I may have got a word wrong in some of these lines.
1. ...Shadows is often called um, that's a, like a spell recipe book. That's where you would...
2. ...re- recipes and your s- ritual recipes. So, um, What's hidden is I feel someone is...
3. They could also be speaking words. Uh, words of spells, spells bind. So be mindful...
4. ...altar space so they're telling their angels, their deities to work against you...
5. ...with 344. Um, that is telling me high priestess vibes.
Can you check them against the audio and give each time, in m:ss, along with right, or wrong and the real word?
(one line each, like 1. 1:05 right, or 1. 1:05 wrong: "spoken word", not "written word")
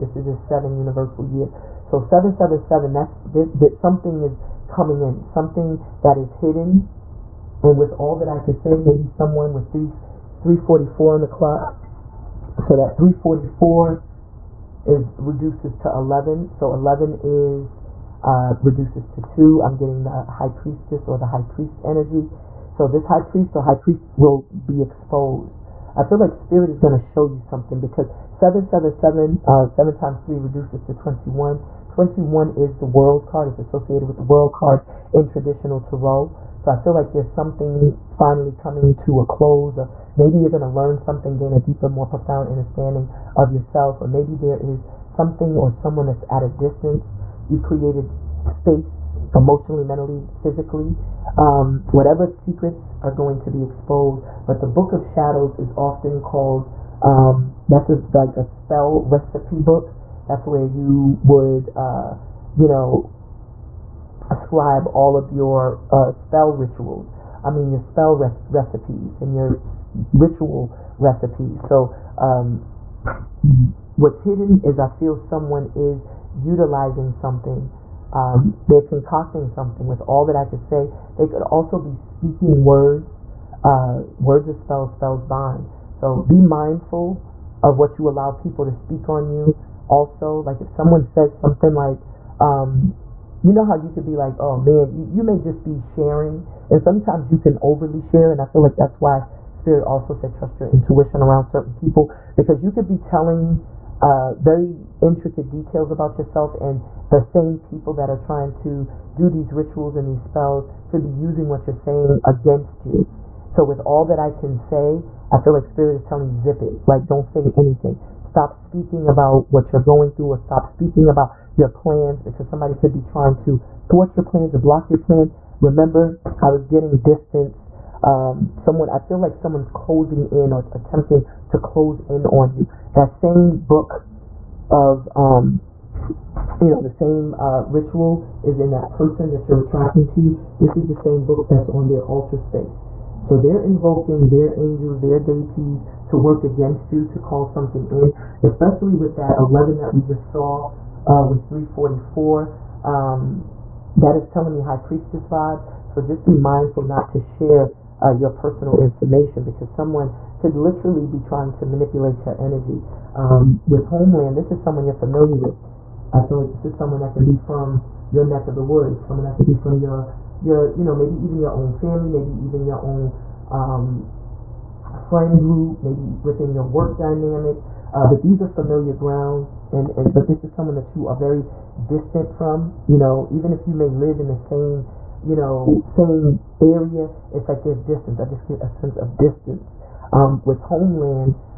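1. 0:55 right
2. 1:08 right
3. 1:21 right
4. 2:22 wrong: "invoking", not "telling"
5. 2:31 right.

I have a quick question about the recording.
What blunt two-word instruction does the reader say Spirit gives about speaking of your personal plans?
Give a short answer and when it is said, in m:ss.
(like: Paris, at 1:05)
Zip it, at 1:56.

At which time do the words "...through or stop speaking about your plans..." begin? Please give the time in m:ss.
2:00.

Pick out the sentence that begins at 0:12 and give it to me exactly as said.
So that three forty four is reduces to eleven.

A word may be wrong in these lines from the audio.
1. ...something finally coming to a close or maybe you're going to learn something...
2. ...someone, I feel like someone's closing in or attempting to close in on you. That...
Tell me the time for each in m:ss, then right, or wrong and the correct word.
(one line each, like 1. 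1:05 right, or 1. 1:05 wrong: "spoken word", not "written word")
1. 0:37 right
2. 2:08 right.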